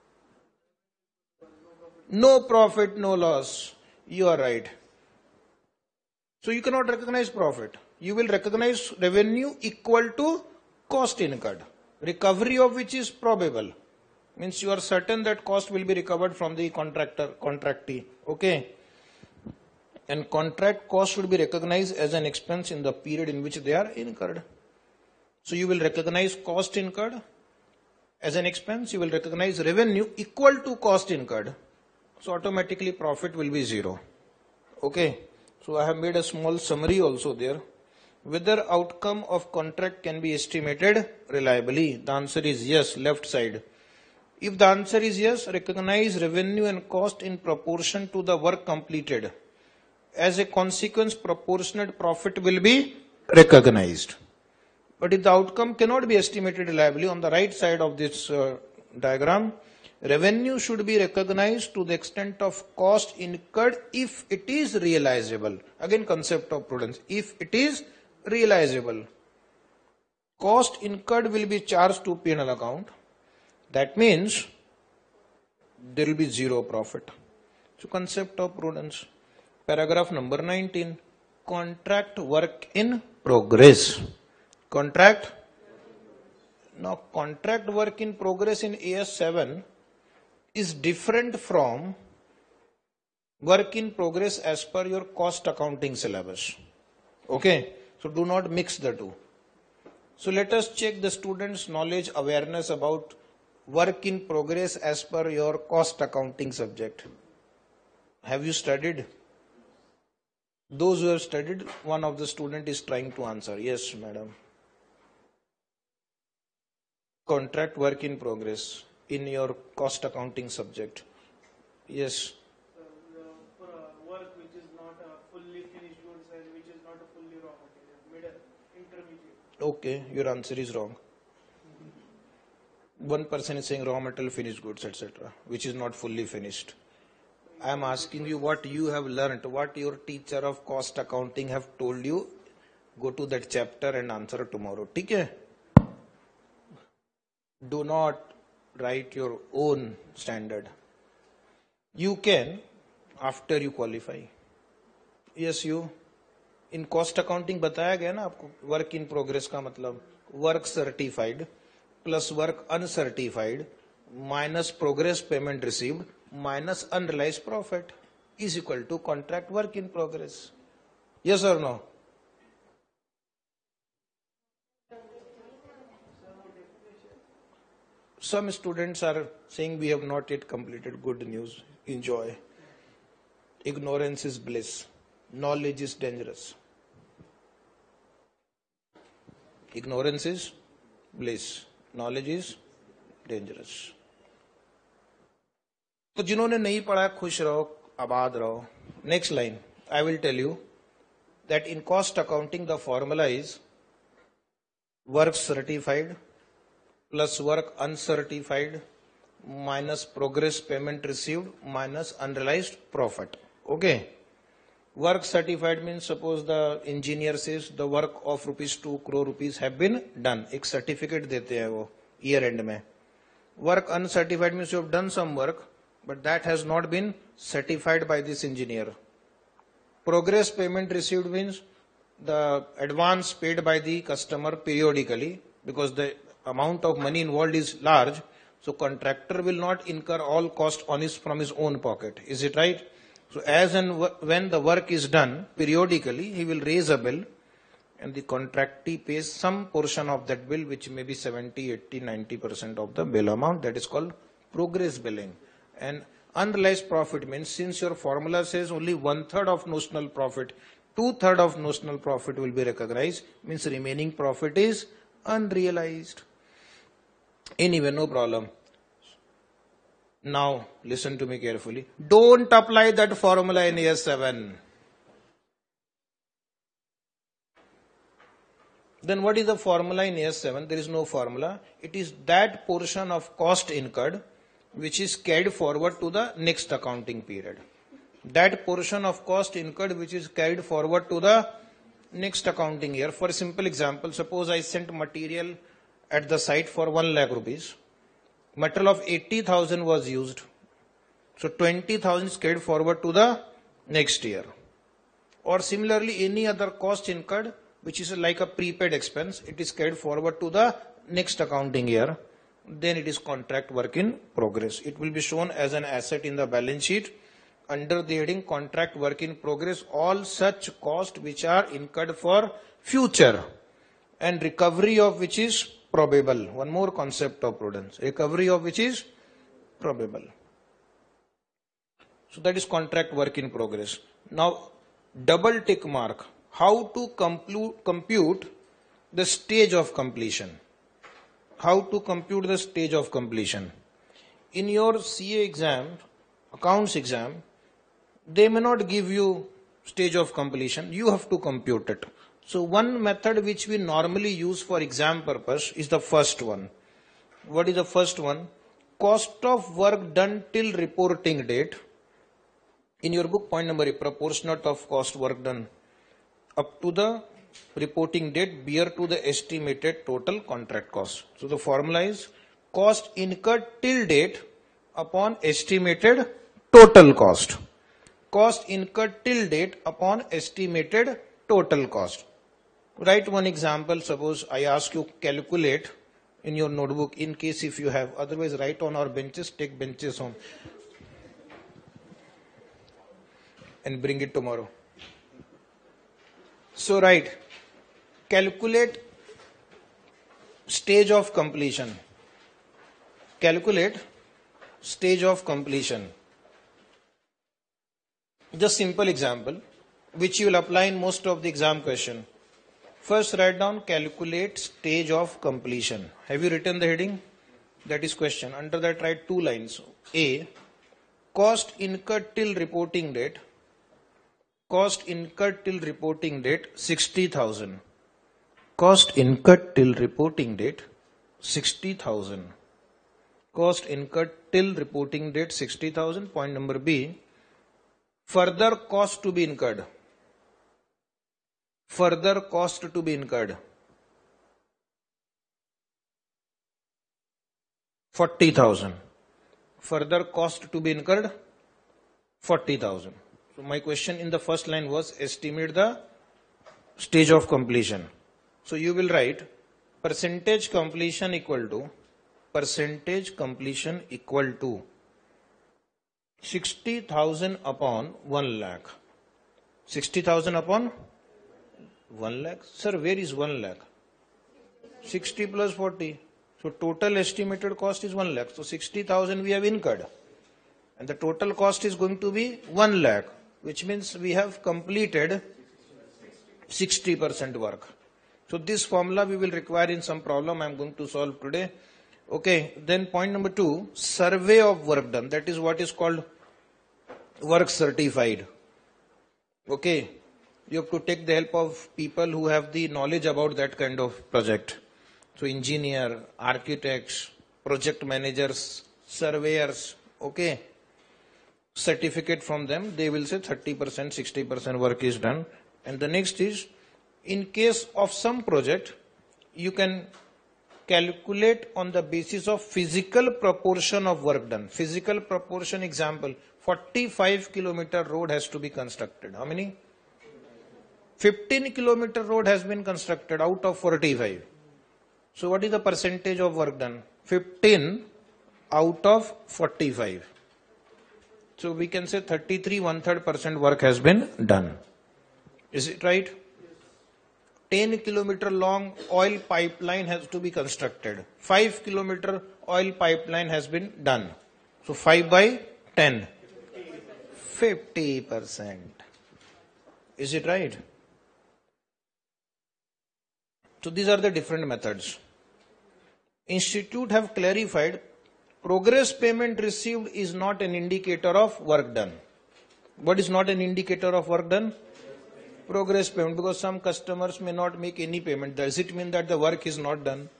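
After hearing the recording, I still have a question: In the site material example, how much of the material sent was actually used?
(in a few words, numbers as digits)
80,000.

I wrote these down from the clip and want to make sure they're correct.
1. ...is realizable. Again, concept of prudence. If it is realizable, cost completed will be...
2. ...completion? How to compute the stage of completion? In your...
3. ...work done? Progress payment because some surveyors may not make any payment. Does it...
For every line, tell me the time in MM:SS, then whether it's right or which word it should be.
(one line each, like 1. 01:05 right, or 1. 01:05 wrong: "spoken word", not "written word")
1. 01:04 wrong: "incurred", not "completed"
2. 05:39 right
3. 09:34 wrong: "customers", not "surveyors".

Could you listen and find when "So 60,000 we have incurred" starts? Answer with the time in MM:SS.
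07:58.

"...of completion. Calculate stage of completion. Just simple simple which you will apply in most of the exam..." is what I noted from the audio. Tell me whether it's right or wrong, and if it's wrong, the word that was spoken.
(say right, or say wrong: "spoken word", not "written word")
wrong: "example", not "simple".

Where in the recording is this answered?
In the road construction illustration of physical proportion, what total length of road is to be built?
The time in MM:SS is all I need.
08:46.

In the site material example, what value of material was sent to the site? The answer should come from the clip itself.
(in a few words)
1 lakh rupees.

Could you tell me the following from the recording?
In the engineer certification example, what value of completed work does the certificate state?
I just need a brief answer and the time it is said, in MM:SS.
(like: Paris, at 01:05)
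2 crore rupees, at 03:38.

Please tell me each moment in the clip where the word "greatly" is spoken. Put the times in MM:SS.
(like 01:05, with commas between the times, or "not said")
not said.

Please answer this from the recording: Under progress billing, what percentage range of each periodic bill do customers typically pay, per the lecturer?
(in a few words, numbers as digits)
70, 80, 90%.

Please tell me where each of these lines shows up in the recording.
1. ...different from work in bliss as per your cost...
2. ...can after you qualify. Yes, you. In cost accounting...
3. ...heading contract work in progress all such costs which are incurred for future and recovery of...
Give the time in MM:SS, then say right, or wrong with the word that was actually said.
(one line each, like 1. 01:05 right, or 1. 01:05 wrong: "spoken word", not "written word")
1. 01:30 wrong: "progress", not "bliss"
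2. 02:32 right
3. 05:18 right.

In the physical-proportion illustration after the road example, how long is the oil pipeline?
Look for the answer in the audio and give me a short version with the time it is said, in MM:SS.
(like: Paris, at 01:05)
10 kilometer, at 09:07.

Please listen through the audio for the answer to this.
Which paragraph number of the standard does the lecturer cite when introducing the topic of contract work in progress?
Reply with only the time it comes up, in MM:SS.
01:19.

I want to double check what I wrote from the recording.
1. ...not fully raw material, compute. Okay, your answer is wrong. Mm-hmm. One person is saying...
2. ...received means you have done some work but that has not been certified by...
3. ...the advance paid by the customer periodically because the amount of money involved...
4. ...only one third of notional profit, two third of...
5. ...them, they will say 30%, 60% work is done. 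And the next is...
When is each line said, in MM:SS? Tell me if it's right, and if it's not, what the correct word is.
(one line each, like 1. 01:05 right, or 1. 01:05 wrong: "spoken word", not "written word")
1. 02:06 wrong: "intermediate", not "compute"
2. 03:43 wrong: "uncertified", not "received"
3. 03:52 right
4. 04:18 right
5. 08:32 right.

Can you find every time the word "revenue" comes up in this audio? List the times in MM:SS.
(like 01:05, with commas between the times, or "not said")
00:08, 00:29, 00:46, 01:00.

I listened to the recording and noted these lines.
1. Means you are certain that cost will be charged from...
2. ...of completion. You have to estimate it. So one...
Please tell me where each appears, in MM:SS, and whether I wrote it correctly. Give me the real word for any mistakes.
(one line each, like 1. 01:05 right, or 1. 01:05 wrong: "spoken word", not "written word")
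1. 00:14 wrong: "recovered", not "charged"
2. 05:50 wrong: "compute", not "estimate".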